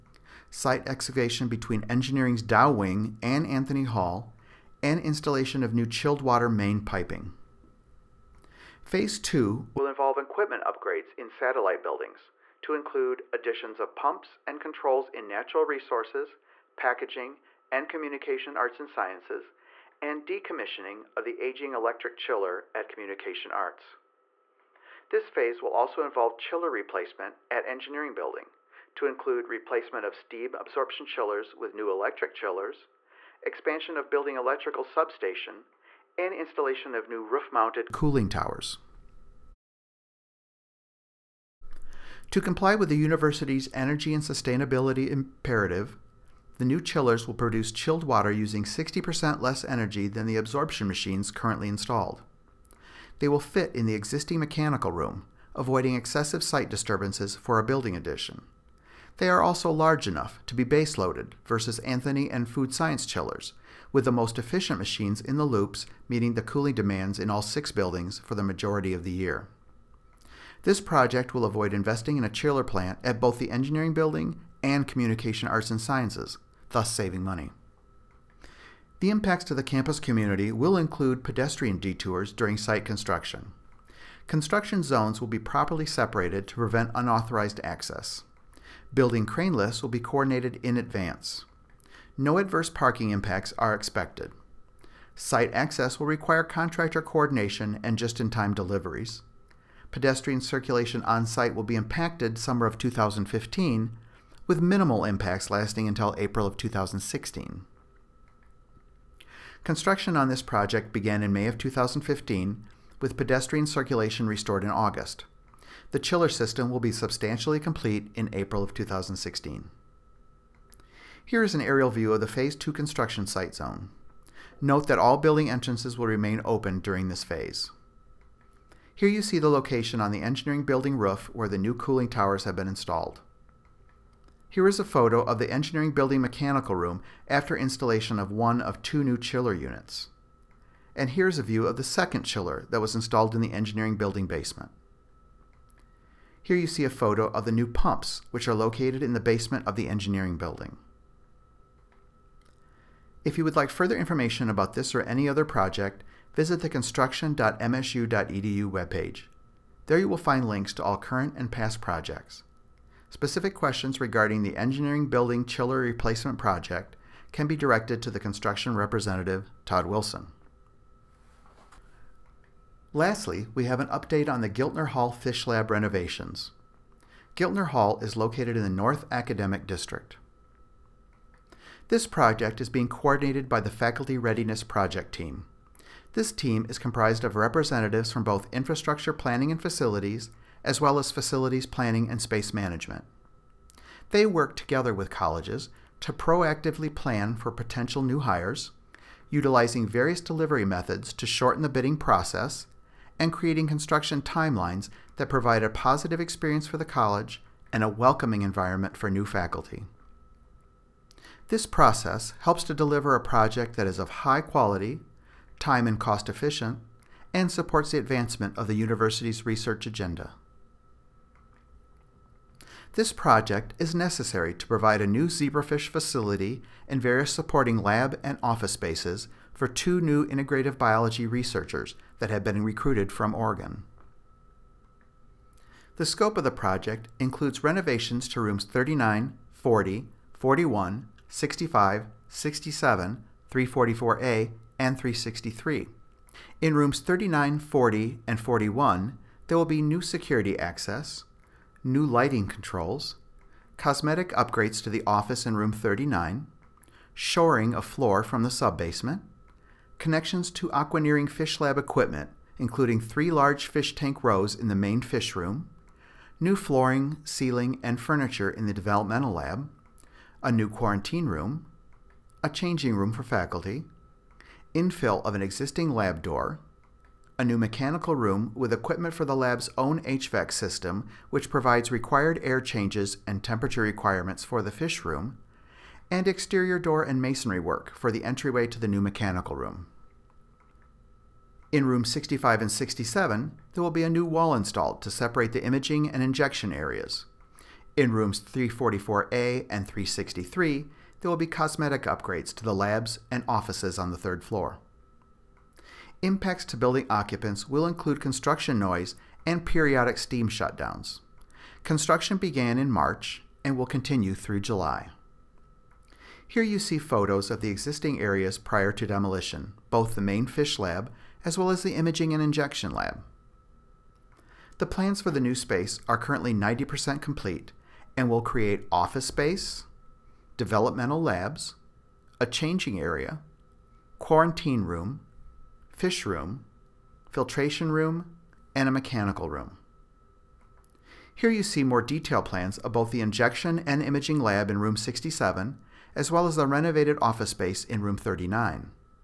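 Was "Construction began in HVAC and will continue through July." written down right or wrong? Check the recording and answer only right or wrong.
wrong.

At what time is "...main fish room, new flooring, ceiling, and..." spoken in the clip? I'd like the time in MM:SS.
04:24.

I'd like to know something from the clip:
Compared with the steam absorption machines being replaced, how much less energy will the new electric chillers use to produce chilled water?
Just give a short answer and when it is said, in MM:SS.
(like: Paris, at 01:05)
60%, at 00:48.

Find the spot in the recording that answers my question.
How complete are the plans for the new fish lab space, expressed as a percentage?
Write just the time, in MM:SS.
05:26.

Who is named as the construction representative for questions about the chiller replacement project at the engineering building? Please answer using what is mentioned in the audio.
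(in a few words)
Todd Wilson.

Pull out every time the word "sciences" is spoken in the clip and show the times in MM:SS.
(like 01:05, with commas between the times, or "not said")
00:18, 01:02, 01:15.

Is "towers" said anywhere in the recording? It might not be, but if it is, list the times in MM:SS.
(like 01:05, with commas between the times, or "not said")
00:38, 02:12.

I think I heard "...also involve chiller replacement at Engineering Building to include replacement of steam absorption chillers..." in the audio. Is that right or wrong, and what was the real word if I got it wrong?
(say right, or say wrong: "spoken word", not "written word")
right.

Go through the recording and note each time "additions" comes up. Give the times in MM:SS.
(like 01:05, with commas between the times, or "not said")
00:13, 00:57.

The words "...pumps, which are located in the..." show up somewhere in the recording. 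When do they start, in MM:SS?
02:27.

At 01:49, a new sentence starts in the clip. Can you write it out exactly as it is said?
Construction on this project began in May of 2015, with pedestrian circulation restored in August.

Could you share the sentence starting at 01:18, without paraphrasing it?
The impacts to the campus community will include pedestrian detours during site construction.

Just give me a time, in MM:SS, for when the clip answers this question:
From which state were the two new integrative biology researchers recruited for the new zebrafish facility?
03:53.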